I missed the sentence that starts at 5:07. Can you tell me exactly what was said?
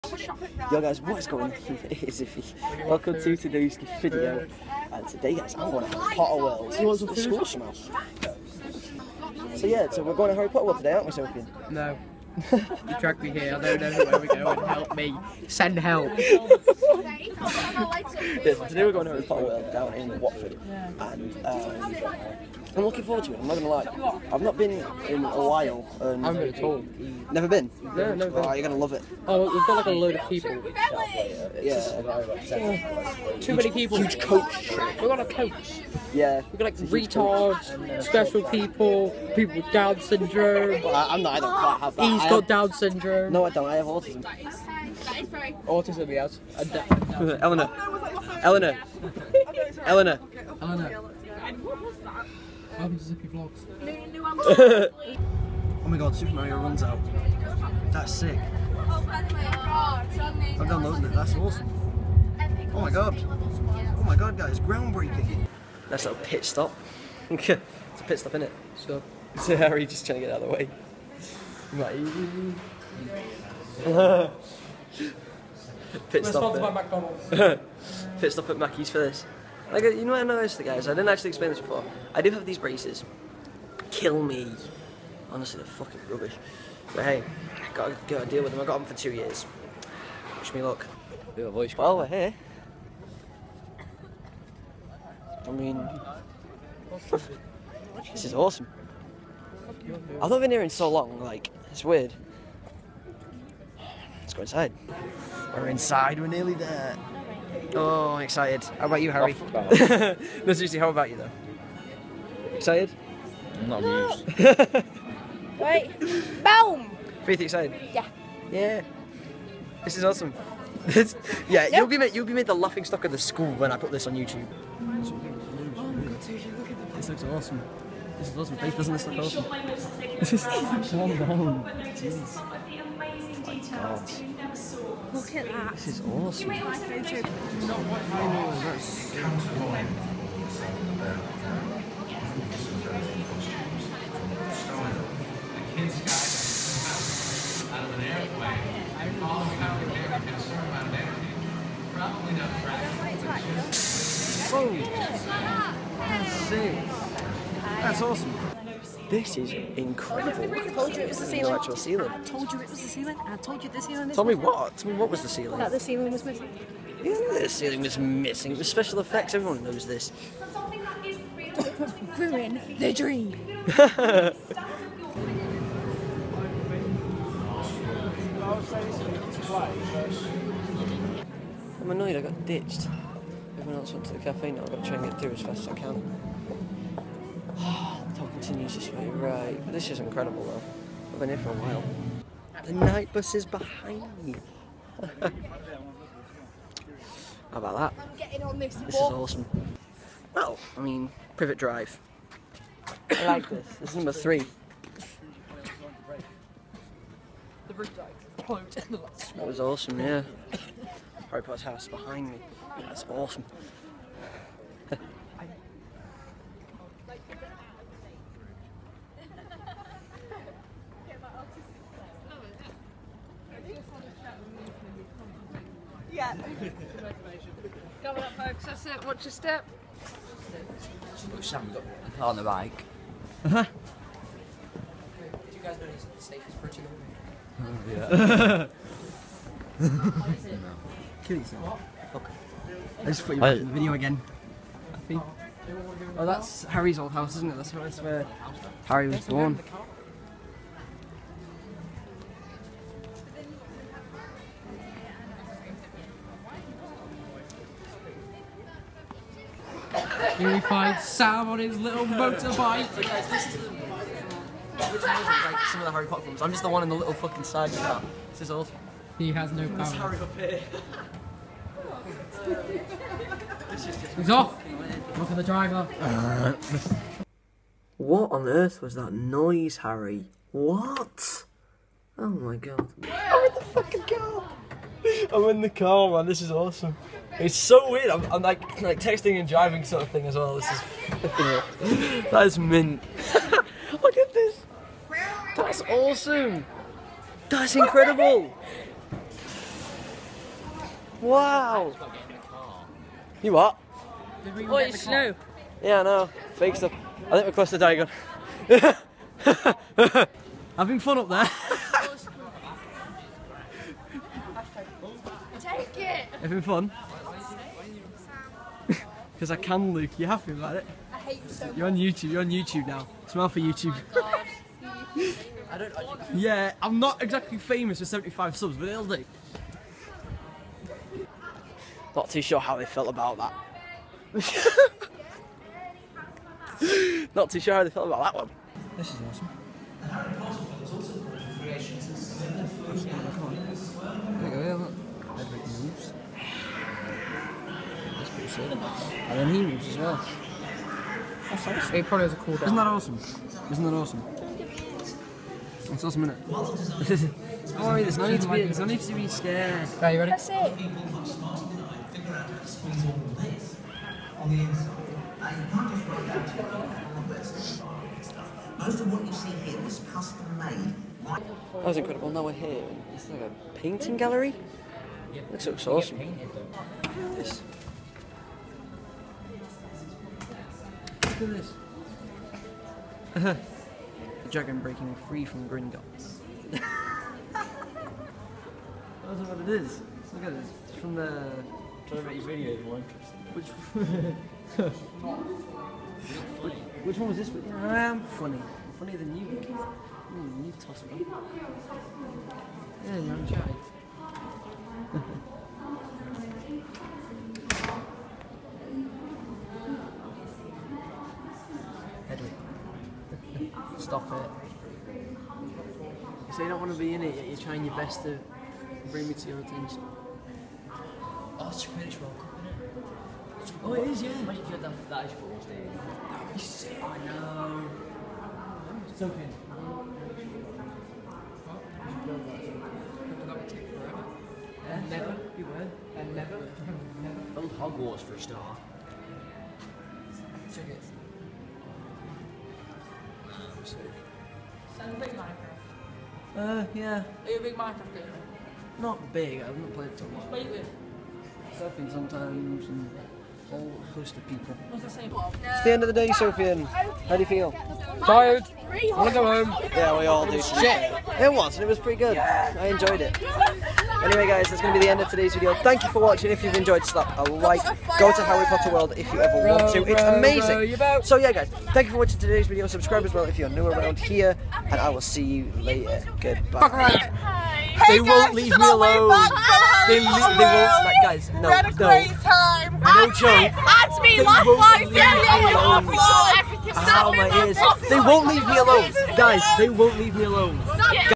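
I think we're close to Having fun up there.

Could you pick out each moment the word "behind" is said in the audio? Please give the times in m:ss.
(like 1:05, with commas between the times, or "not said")
3:13, 3:31.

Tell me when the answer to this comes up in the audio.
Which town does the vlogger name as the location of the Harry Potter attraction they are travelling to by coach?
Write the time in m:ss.
0:20.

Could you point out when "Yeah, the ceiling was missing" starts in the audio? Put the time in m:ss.
2:47.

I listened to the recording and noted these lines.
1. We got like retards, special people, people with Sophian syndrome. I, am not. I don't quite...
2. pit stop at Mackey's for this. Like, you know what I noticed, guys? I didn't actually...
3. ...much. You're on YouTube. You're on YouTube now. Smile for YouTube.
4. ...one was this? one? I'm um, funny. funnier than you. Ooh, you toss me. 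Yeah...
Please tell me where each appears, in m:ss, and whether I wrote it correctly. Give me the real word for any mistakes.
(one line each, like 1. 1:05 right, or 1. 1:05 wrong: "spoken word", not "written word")
1. 0:36 wrong: "Down", not "Sophian"
2. 1:18 right
3. 5:21 right
4. 6:37 right.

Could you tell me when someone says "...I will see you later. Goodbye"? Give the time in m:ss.
7:54.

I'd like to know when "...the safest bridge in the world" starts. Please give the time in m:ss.
3:56.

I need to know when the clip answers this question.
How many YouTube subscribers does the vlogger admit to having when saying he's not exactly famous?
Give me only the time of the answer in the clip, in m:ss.
5:28.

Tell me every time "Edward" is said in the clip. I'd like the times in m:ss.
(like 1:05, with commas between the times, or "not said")
5:45.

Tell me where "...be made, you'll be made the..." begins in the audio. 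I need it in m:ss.
2:01.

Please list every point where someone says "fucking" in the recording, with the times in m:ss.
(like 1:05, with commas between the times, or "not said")
1:25, 4:27, 4:43.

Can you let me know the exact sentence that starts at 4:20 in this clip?
Here we find Sam on his little motorbike.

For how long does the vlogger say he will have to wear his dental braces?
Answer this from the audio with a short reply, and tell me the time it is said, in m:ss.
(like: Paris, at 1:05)
2 years, at 1:28.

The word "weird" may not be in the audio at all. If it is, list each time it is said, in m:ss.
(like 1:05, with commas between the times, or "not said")
1:41, 4:47.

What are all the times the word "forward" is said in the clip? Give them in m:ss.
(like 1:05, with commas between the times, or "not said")
0:23.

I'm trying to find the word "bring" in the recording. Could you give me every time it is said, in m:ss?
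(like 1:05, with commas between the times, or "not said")
6:59.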